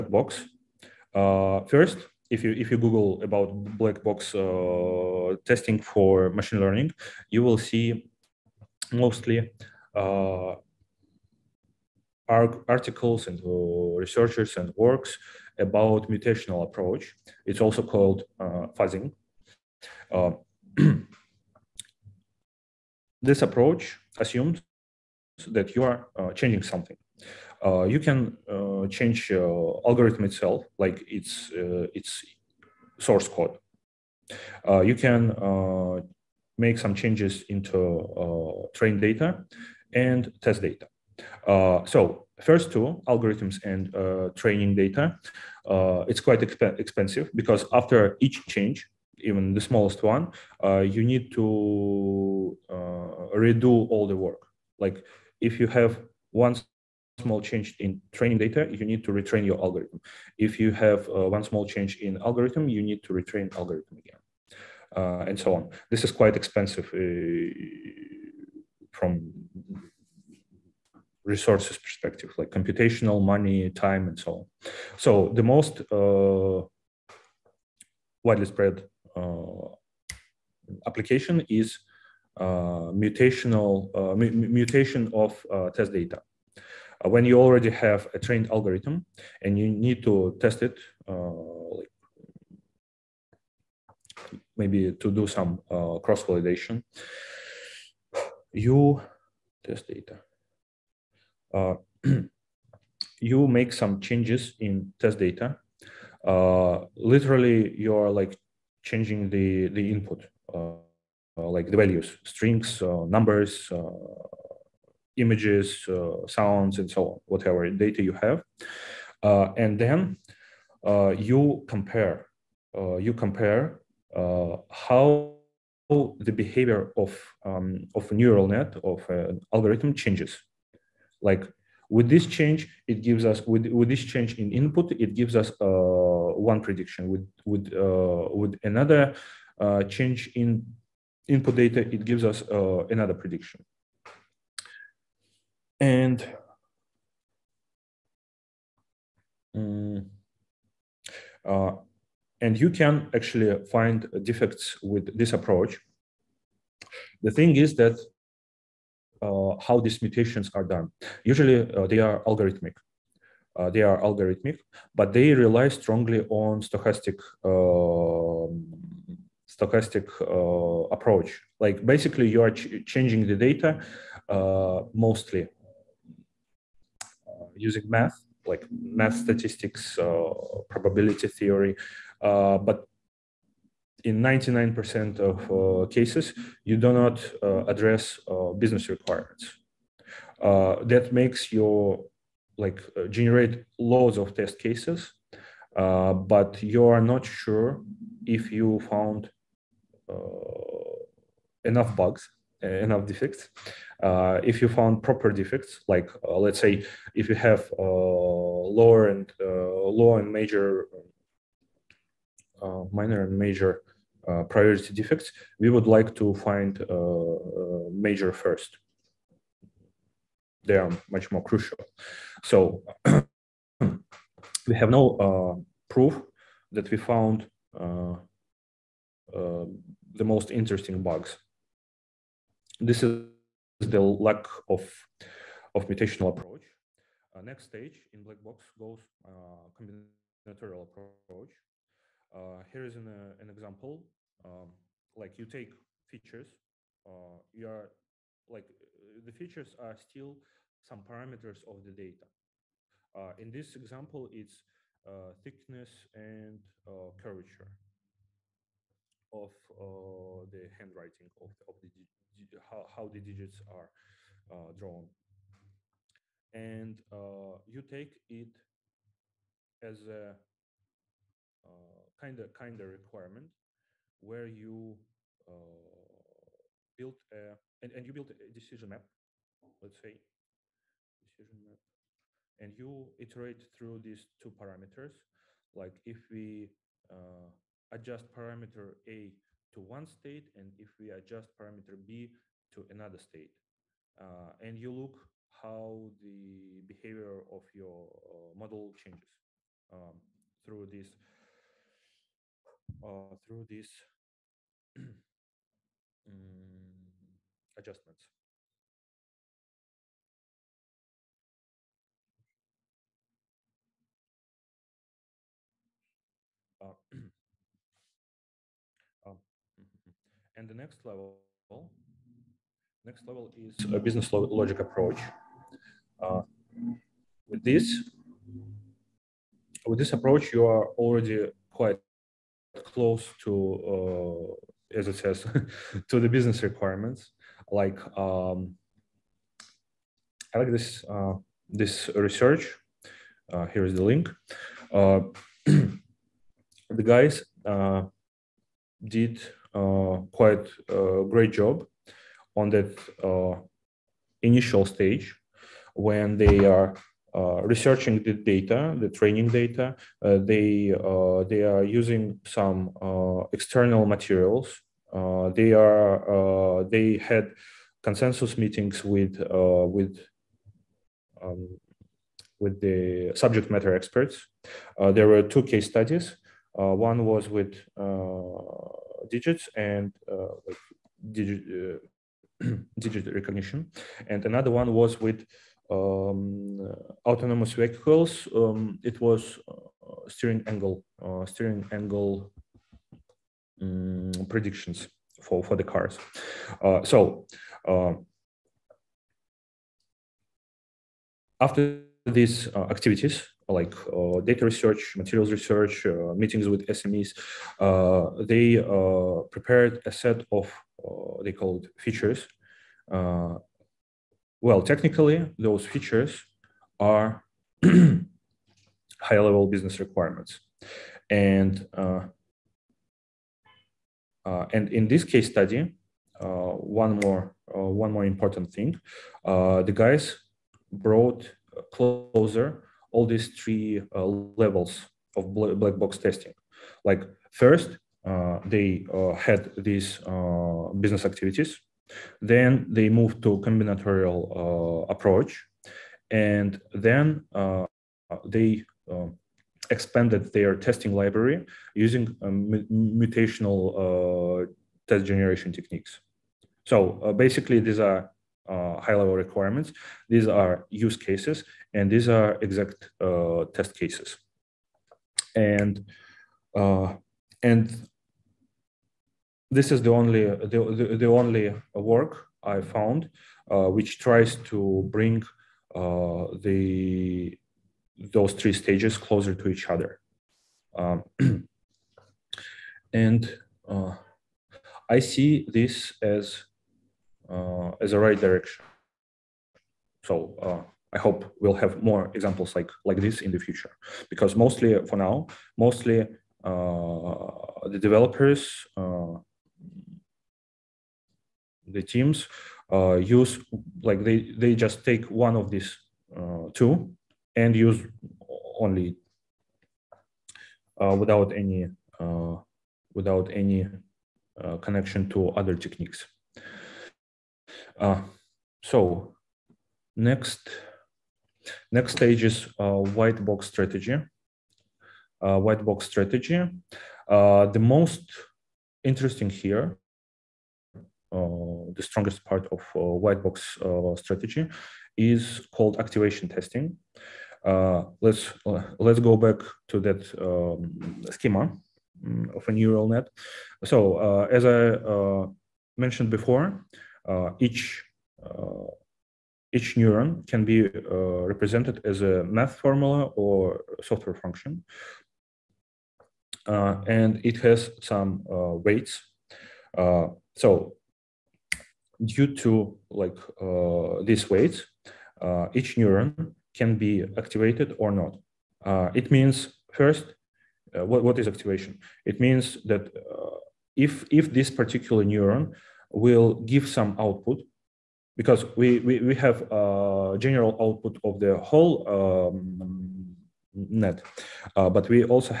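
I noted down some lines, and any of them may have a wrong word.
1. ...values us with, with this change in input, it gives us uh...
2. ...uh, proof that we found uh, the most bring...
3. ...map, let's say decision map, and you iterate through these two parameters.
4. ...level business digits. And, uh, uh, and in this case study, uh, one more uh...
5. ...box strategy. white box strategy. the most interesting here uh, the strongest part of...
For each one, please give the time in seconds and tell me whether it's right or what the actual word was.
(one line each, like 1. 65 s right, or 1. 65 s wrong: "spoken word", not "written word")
1. 133 s wrong: "gives", not "values"
2. 225 s wrong: "interesting", not "bring"
3. 278 s right
4. 419 s wrong: "requirements", not "digits"
5. 523 s right.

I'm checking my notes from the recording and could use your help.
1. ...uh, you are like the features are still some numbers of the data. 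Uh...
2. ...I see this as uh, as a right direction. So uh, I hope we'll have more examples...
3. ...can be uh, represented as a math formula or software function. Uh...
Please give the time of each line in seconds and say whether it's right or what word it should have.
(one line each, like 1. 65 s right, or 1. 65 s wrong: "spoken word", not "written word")
1. 247 s wrong: "parameters", not "numbers"
2. 485 s right
3. 550 s right.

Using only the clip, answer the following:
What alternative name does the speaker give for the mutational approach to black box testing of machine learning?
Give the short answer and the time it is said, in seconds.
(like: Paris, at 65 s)
Fuzzing, at 18 s.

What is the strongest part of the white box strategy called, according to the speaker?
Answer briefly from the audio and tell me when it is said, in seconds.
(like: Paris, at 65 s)
Activation testing, at 535 s.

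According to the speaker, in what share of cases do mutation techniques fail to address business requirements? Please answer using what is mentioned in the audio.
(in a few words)
99%.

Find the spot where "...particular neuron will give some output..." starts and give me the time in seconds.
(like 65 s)
574 s.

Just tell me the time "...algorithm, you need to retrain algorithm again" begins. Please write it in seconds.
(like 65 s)
62 s.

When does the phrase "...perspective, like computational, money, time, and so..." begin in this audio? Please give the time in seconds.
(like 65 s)
71 s.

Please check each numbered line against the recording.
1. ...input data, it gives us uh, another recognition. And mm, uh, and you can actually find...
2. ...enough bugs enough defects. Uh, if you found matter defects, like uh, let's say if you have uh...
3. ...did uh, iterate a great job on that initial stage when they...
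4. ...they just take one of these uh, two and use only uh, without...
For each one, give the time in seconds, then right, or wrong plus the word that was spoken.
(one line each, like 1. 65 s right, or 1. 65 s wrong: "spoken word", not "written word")
1. 141 s wrong: "prediction", not "recognition"
2. 201 s wrong: "proper", not "matter"
3. 349 s wrong: "quite", not "iterate"
4. 504 s right.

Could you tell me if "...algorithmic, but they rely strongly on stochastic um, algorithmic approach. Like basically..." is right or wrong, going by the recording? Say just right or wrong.
wrong.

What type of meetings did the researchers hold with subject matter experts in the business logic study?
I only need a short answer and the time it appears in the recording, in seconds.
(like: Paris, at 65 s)
Consensus meetings, at 368 s.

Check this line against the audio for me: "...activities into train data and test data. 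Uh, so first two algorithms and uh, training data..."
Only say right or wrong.
wrong.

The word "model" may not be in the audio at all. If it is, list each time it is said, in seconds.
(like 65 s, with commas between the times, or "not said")
298 s.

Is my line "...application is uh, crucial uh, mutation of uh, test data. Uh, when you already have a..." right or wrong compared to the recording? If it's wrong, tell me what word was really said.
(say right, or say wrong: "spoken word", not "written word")
wrong: "mutational", not "crucial".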